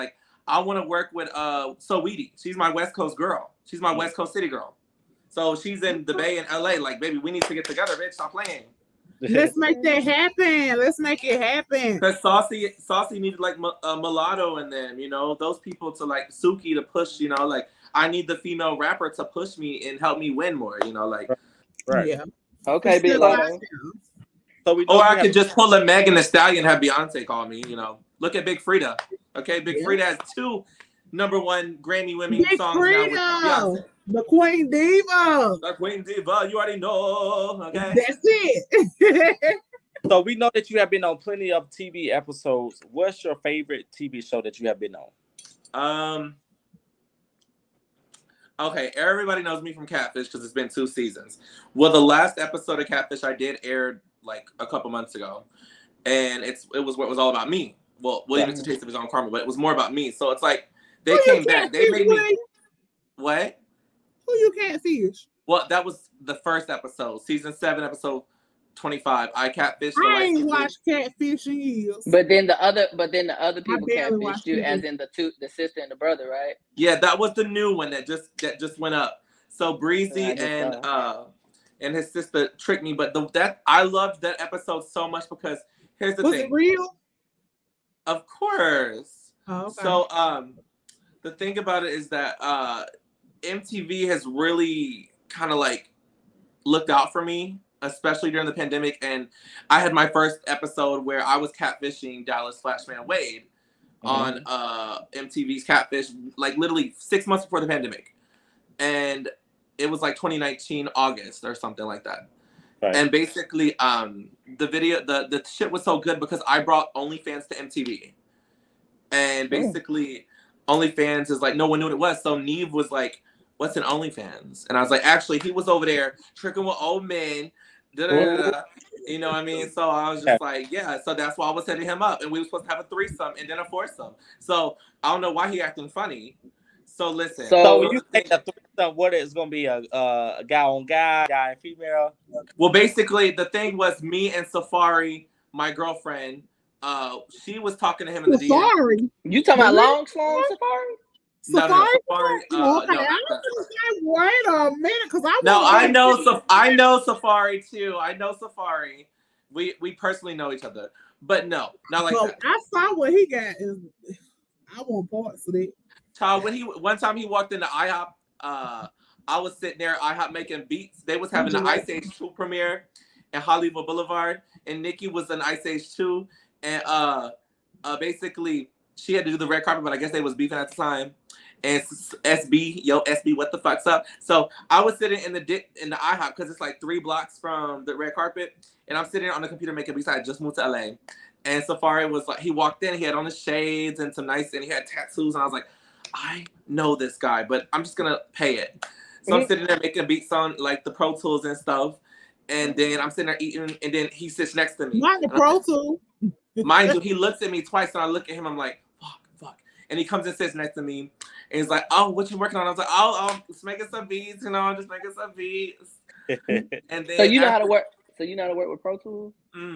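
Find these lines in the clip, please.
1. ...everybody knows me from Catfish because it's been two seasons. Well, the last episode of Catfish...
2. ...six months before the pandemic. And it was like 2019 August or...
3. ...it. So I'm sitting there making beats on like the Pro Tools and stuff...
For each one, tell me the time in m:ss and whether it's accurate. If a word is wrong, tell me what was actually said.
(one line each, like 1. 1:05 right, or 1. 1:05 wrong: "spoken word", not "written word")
1. 0:48 right
2. 1:46 right
3. 3:18 right.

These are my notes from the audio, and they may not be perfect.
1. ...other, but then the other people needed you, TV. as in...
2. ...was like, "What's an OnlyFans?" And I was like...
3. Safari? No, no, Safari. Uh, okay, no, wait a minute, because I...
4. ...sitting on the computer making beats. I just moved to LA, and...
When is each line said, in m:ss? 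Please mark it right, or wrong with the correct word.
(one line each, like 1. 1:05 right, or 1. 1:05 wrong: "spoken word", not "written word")
1. 1:12 wrong: "catfished", not "needed"
2. 2:02 right
3. 2:31 right
4. 3:09 right.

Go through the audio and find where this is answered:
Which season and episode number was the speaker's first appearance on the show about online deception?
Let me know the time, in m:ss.
1:07.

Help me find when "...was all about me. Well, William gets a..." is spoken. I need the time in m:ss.
0:57.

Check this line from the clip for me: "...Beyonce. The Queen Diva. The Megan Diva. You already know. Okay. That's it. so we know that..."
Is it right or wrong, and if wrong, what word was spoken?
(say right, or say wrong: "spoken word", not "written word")
wrong: "Queen", not "Megan".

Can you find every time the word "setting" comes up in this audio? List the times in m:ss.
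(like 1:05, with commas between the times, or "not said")
2:11.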